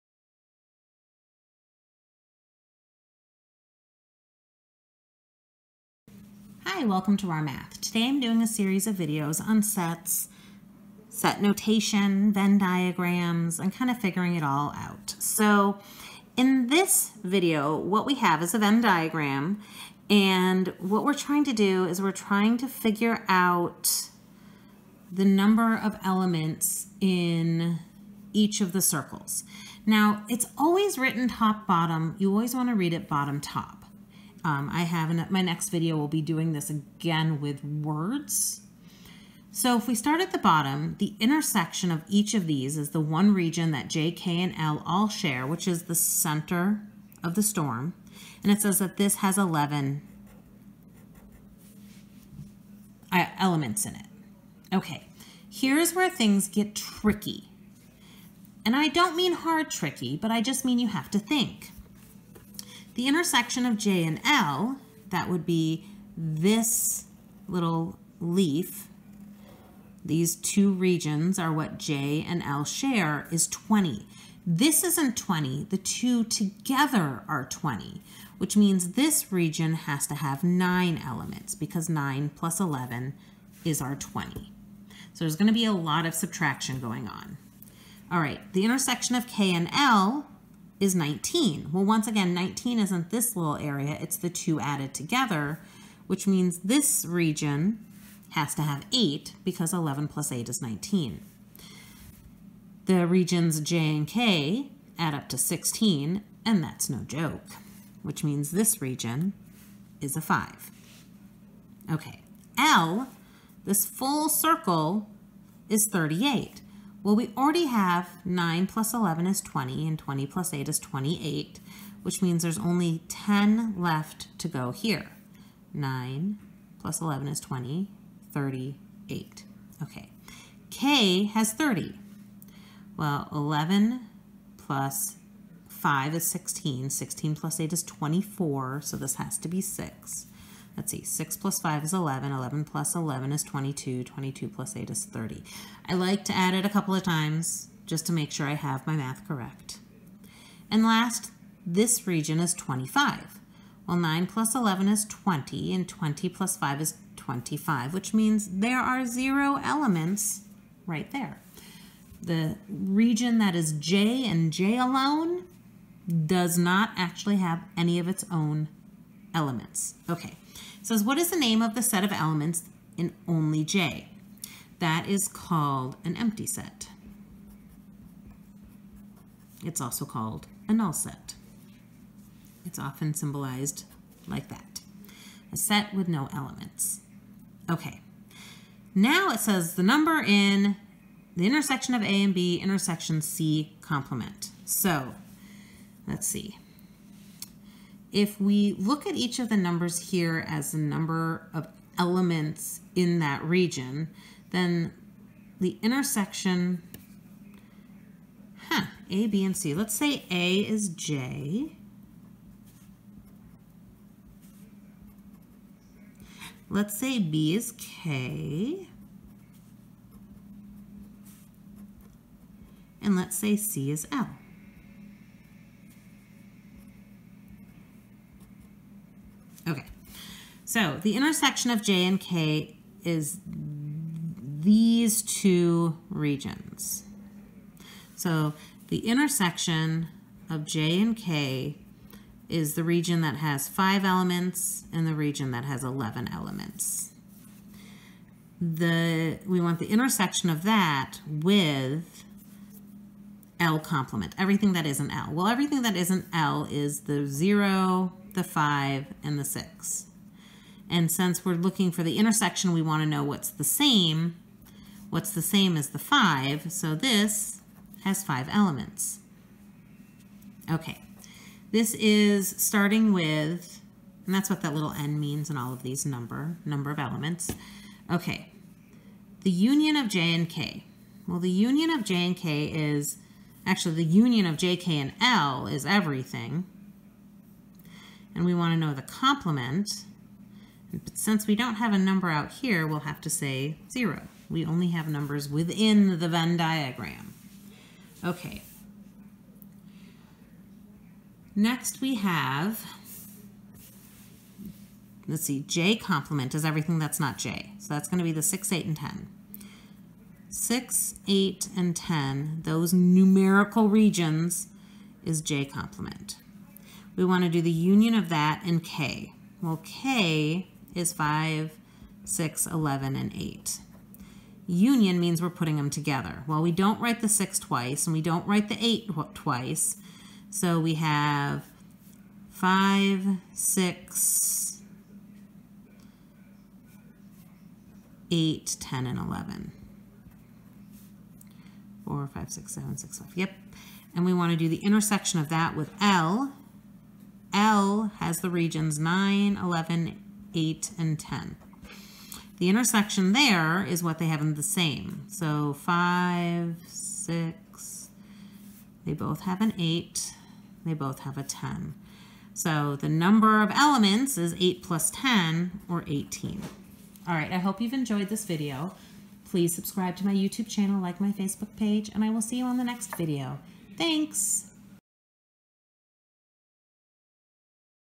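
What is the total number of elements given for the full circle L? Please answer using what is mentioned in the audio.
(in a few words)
38.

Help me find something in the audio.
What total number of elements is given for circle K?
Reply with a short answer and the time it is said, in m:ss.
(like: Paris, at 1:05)
30, at 2:10.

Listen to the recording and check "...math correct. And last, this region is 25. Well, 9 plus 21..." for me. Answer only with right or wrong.
wrong.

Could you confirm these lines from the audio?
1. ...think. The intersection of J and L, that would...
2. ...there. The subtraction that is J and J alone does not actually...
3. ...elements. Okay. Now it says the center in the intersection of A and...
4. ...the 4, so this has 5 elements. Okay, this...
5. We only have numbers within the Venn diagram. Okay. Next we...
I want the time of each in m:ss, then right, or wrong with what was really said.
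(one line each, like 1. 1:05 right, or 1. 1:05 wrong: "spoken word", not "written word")
1. 1:01 right
2. 2:41 wrong: "region", not "subtraction"
3. 3:06 wrong: "number", not "center"
4. 4:25 wrong: "5", not "4"
5. 4:54 right.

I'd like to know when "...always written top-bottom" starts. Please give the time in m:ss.
0:30.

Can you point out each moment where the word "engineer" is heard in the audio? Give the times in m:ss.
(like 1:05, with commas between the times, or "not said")
not said.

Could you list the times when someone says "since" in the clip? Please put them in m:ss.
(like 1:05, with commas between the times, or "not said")
4:21, 4:51.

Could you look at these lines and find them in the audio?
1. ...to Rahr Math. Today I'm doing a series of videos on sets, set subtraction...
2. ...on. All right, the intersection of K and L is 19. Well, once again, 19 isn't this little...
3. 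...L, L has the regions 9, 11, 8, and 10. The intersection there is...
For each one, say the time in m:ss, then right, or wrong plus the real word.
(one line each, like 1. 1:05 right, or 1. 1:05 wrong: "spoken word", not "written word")
1. 0:07 wrong: "notation", not "subtraction"
2. 1:27 right
3. 5:46 right.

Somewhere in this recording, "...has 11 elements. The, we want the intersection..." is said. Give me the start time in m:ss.
4:05.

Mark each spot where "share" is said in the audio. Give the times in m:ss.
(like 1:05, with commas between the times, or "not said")
0:45, 1:12.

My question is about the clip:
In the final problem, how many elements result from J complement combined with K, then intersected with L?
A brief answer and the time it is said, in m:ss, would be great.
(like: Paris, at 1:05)
18, at 6:06.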